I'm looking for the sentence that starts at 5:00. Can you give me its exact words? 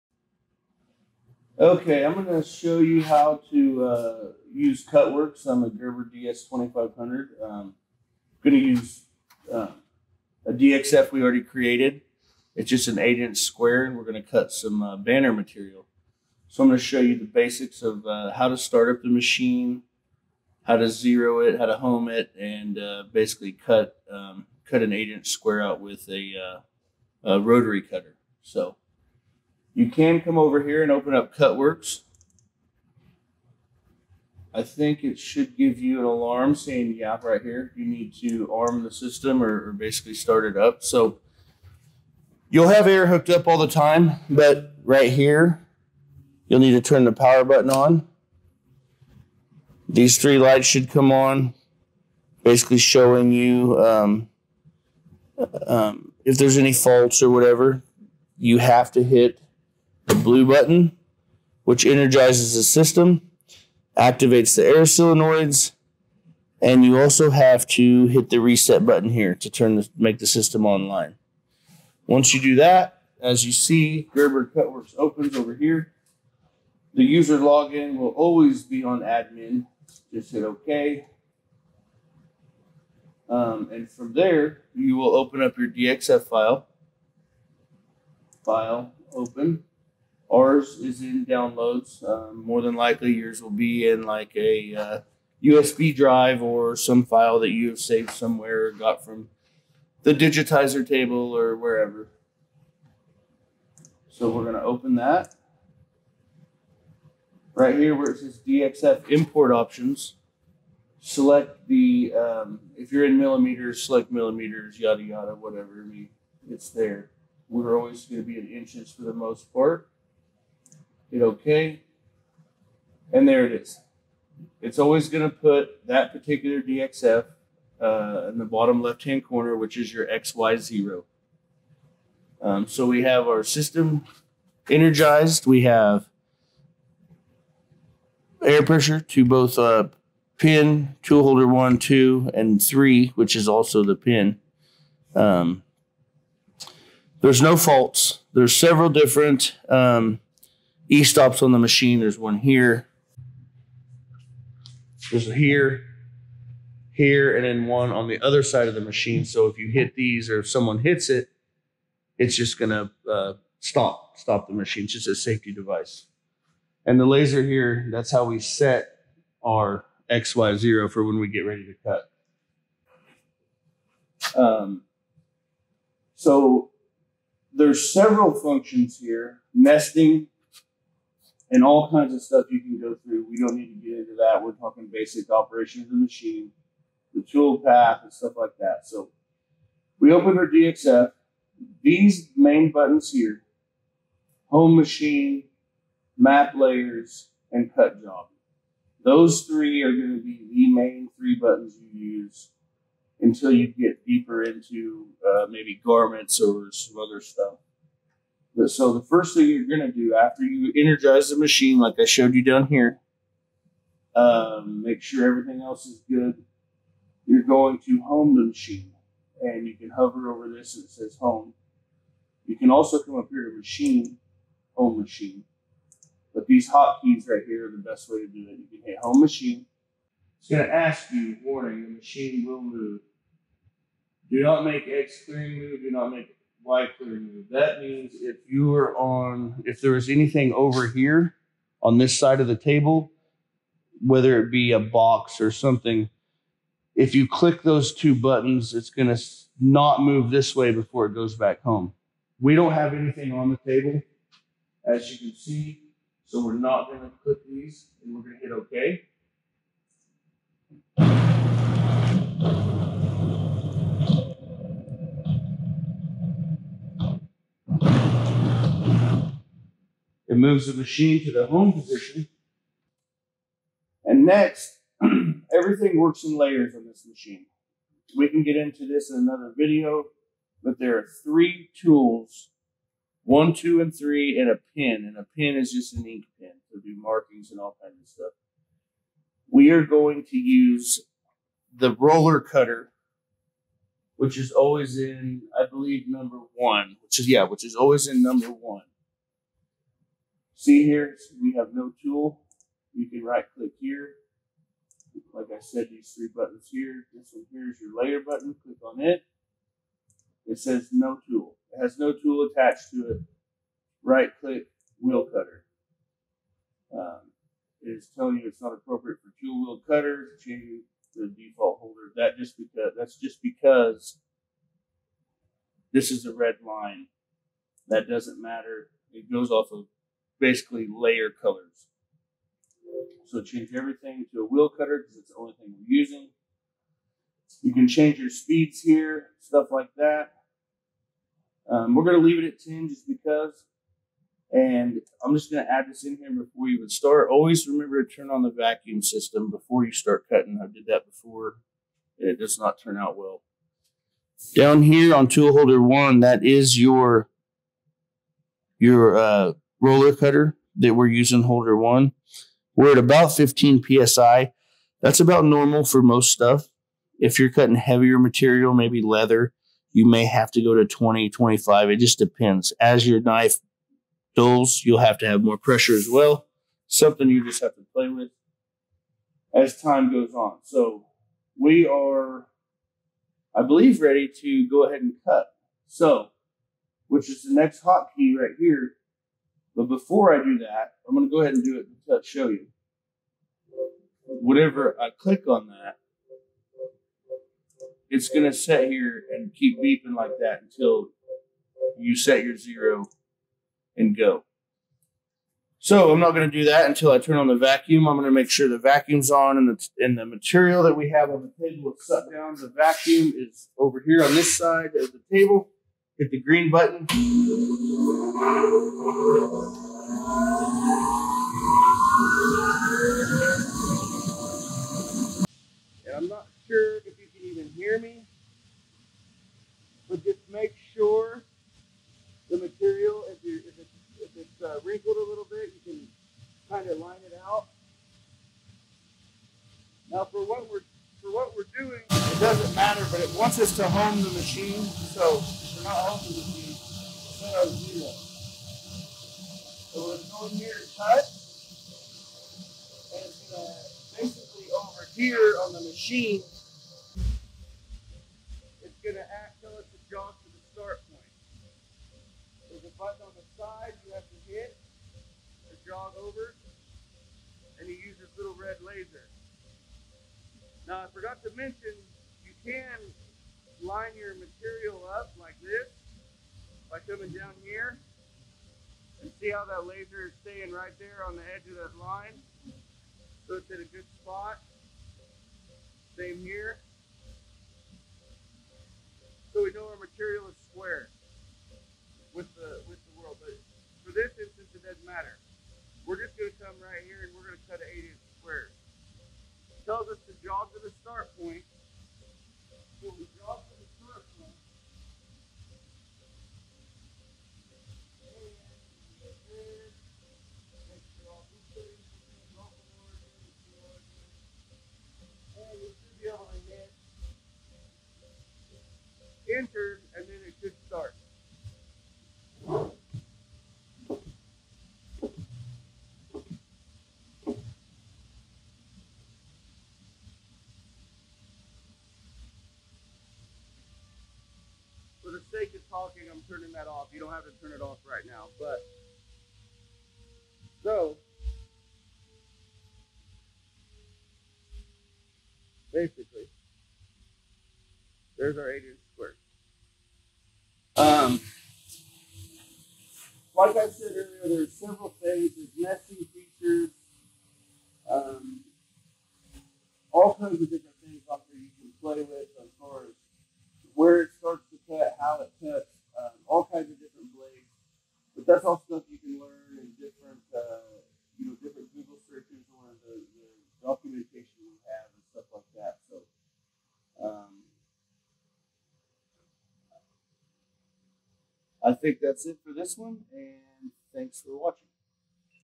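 See here, we have no tool.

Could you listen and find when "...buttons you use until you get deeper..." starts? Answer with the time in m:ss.
3:21.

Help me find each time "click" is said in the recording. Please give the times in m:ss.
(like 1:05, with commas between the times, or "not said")
4:07, 4:17, 5:03, 5:08, 5:14, 6:35.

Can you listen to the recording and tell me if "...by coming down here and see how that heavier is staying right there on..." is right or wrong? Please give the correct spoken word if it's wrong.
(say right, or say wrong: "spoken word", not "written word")
wrong: "laser", not "heavier".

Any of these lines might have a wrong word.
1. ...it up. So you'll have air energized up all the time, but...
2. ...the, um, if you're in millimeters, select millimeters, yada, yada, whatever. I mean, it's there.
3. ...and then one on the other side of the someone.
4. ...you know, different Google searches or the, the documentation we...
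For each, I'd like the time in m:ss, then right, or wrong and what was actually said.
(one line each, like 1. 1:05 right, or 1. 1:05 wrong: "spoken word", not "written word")
1. 0:40 wrong: "hooked", not "energized"
2. 1:51 right
3. 2:37 wrong: "machine", not "someone"
4. 9:31 right.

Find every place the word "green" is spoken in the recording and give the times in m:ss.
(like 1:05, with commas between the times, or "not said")
6:56.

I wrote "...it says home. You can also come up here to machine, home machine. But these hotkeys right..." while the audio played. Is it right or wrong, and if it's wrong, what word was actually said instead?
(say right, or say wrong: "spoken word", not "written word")
right.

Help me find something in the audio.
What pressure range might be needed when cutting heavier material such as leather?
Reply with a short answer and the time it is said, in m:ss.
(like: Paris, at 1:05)
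20 to 25, at 6:10.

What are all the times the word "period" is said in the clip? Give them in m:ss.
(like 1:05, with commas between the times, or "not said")
not said.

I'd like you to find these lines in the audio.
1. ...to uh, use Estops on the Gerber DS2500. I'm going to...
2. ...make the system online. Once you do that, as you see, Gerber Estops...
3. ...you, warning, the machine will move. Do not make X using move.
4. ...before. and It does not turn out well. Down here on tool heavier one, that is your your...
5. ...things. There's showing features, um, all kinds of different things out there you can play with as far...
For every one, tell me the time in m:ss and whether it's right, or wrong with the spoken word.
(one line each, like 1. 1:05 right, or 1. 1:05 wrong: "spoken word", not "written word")
1. 0:03 wrong: "Cutworks", not "Estops"
2. 1:09 wrong: "Cutworks", not "Estops"
3. 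3:51 wrong: "clearing", not "using"
4. 5:51 wrong: "holder", not "heavier"
5. 9:15 wrong: "nesting", not "showing".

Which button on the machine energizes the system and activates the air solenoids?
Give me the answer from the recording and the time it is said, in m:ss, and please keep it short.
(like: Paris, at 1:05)
The blue button, at 1:00.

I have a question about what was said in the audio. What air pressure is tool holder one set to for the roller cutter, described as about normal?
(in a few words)
15 PSI.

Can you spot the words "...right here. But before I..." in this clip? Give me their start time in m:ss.
6:28.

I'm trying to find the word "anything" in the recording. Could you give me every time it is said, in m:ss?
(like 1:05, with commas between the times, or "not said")
4:00, 4:12.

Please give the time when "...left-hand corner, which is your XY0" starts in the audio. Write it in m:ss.
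2:08.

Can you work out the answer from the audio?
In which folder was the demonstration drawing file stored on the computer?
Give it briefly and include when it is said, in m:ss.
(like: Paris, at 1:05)
Downloads, at 1:31.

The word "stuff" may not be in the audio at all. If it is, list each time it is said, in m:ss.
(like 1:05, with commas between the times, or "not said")
3:02, 3:08, 3:27, 4:48, 5:39, 6:06, 9:28, 9:35.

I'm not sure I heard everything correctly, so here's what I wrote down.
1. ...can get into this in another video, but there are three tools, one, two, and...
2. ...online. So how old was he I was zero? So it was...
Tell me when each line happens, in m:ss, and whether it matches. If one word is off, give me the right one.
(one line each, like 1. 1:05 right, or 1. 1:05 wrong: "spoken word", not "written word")
1. 4:38 right
2. 7:24 wrong: "machine", not "online".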